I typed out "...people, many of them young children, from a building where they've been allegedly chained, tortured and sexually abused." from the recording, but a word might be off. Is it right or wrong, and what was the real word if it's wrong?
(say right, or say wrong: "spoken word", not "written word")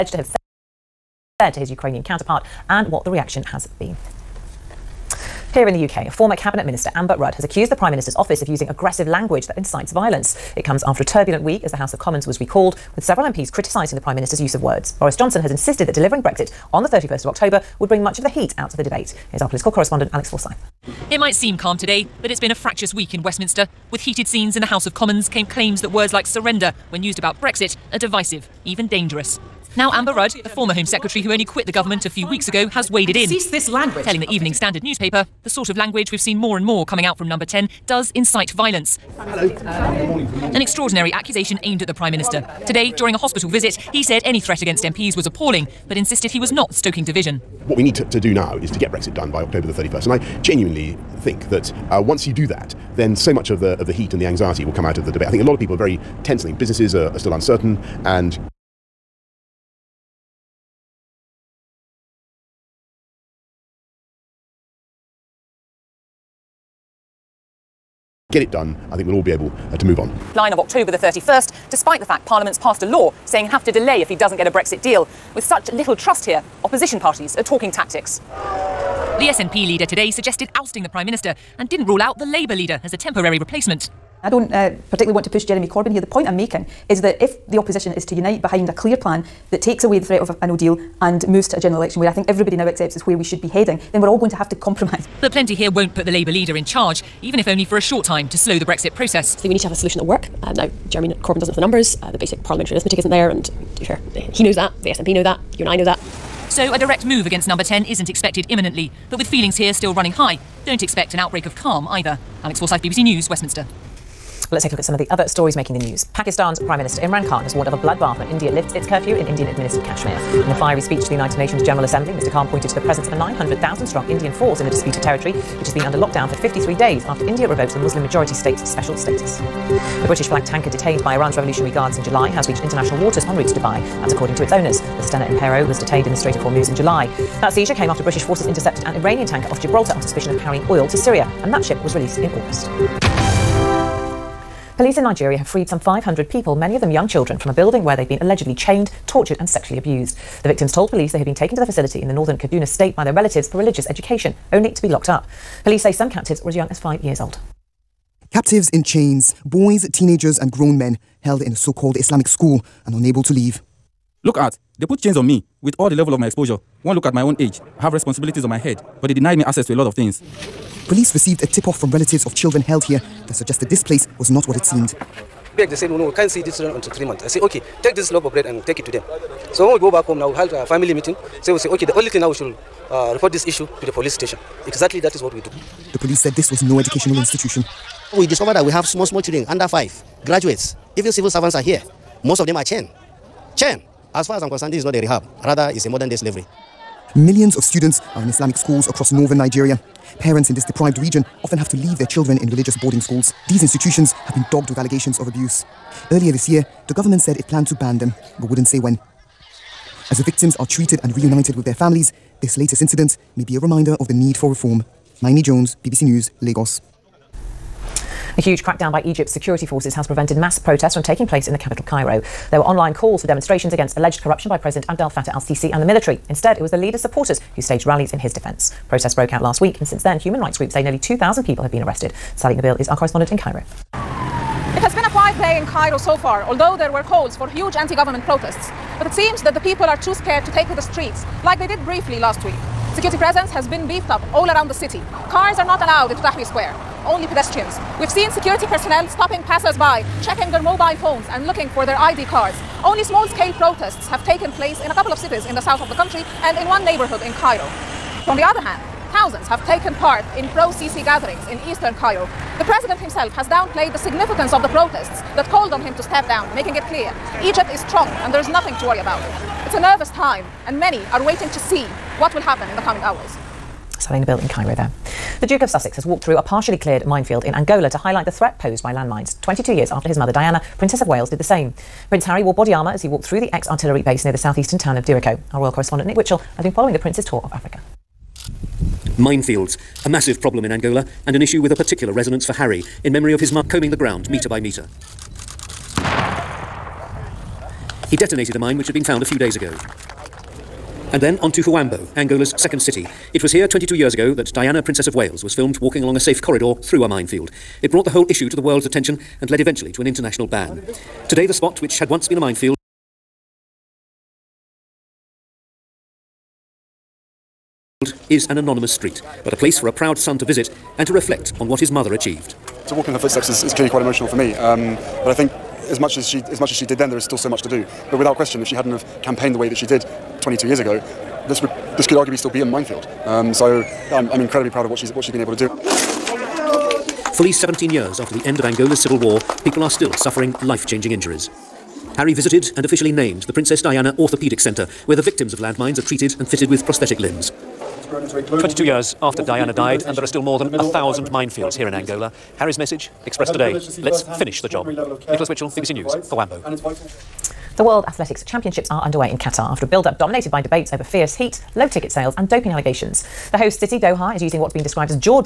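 right.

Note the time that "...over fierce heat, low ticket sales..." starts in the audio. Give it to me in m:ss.
6:00.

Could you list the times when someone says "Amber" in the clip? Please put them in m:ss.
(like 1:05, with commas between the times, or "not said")
0:06, 0:29.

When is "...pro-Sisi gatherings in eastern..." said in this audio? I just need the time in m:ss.
4:20.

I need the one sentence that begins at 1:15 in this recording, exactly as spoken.
With such little trust here, opposition parties are talking tactics.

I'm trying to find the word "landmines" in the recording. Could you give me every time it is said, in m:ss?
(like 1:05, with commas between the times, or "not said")
4:38, 5:45.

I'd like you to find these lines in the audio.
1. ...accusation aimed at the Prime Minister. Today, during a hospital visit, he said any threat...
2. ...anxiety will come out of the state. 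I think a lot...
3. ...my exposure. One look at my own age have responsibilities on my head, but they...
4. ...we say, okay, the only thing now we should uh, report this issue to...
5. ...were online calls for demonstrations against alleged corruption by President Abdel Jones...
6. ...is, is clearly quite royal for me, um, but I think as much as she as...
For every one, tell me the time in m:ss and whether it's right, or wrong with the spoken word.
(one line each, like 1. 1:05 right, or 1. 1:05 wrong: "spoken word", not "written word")
1. 0:41 right
2. 0:54 wrong: "debate", not "state"
3. 2:46 right
4. 3:01 right
5. 3:42 wrong: "Fattah", not "Jones"
6. 5:23 wrong: "emotional", not "royal".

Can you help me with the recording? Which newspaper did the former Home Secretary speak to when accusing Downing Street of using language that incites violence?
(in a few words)
Evening Standard.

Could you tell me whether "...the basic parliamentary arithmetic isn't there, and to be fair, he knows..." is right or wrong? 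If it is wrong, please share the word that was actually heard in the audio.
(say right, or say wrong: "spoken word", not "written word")
right.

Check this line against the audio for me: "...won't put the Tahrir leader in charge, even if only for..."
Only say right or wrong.
wrong.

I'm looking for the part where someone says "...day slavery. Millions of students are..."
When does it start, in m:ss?
3:16.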